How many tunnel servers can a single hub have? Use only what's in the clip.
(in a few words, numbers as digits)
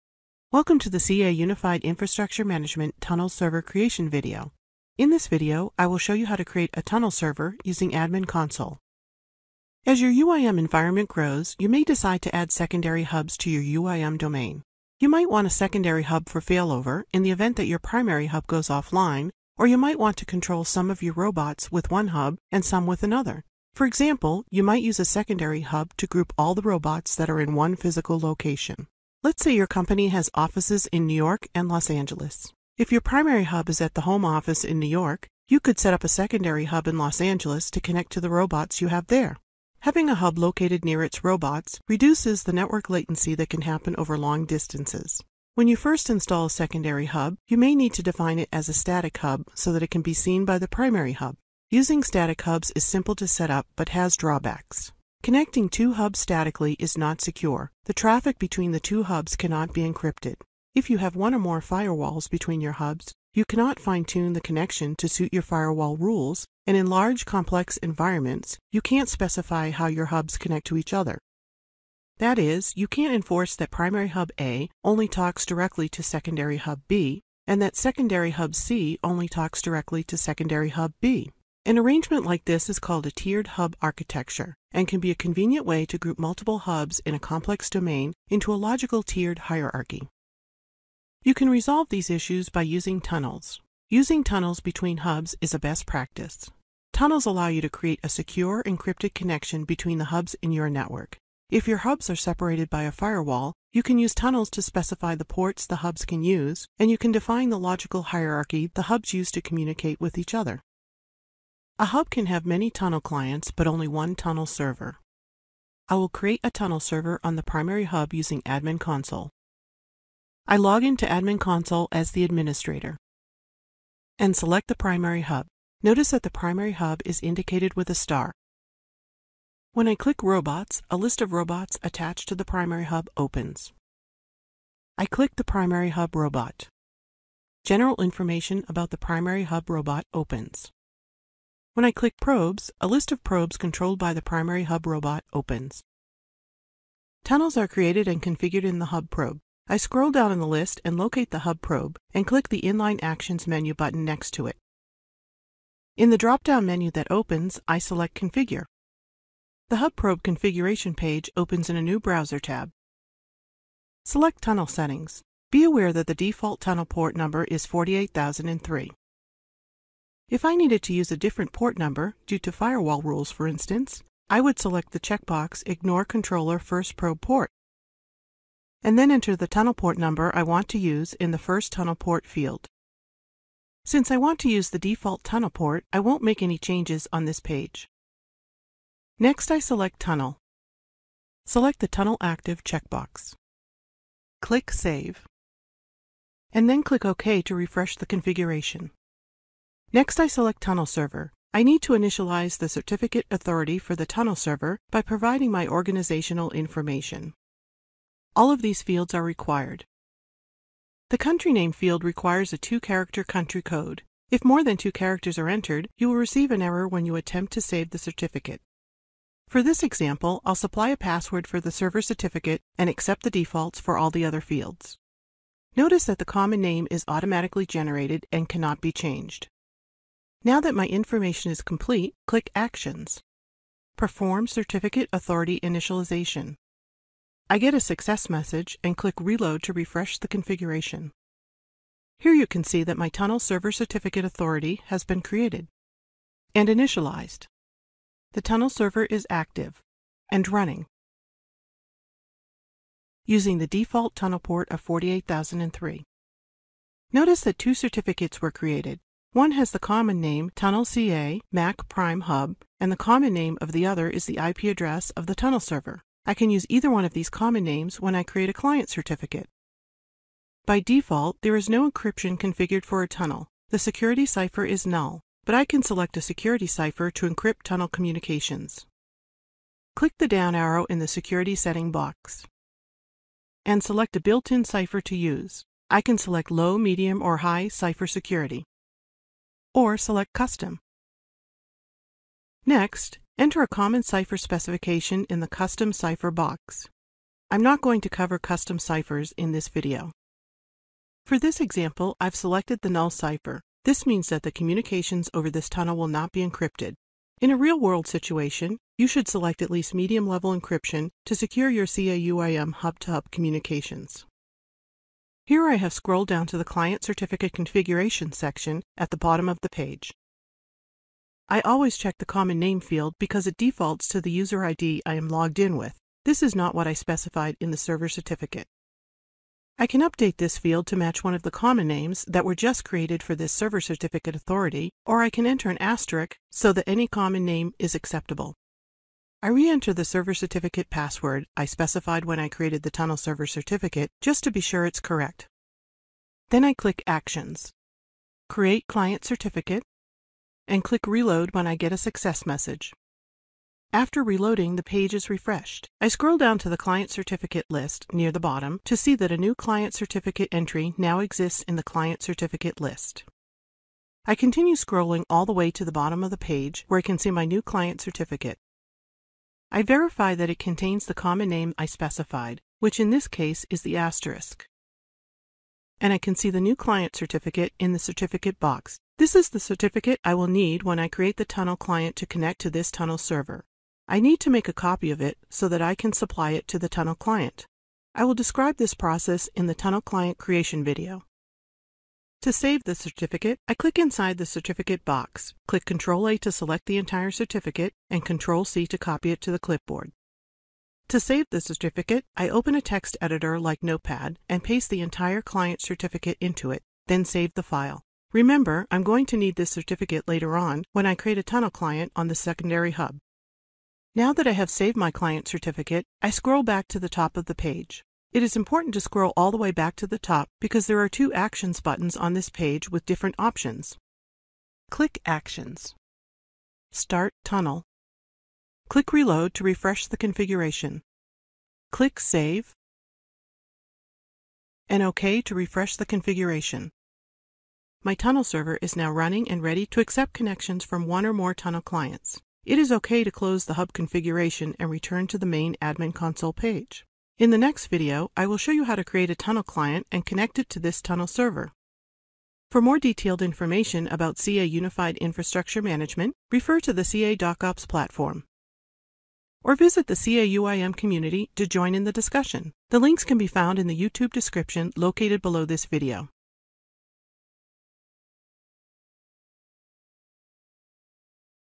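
1.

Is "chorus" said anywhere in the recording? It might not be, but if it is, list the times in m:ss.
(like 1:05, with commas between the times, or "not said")
not said.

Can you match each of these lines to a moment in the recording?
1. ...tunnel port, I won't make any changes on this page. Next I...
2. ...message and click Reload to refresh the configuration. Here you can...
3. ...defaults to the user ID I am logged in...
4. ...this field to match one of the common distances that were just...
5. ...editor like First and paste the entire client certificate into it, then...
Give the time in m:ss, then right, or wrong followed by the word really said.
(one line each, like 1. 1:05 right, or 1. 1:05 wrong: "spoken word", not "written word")
1. 3:05 right
2. 3:58 right
3. 5:23 right
4. 5:30 wrong: "names", not "distances"
5. 6:43 wrong: "Notepad", not "First".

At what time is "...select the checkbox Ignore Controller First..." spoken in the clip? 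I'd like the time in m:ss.
2:54.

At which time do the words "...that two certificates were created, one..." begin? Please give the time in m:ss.
4:17.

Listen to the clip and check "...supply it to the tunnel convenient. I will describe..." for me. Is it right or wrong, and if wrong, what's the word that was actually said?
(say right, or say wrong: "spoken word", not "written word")
wrong: "client", not "convenient".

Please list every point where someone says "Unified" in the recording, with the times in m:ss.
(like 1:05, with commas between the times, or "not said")
0:01, 7:34.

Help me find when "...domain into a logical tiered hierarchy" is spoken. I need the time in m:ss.
1:27.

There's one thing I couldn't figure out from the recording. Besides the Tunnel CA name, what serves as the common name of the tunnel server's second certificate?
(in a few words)
IP address.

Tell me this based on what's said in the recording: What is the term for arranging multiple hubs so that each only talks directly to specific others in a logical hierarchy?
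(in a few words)
Tiered hub architecture.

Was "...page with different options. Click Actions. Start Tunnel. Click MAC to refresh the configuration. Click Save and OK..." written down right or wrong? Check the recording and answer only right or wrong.
wrong.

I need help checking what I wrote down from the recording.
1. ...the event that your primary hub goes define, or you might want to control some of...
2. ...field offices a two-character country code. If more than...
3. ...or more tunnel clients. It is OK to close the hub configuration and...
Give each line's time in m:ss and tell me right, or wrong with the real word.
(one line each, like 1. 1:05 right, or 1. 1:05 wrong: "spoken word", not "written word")
1. 0:17 wrong: "offline", not "define"
2. 3:31 wrong: "requires", not "offices"
3. 7:21 right.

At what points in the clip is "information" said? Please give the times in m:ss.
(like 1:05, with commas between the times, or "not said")
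2:18, 3:26, 3:50, 7:33.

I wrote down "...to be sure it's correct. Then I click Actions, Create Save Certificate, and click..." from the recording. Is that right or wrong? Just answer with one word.
wrong.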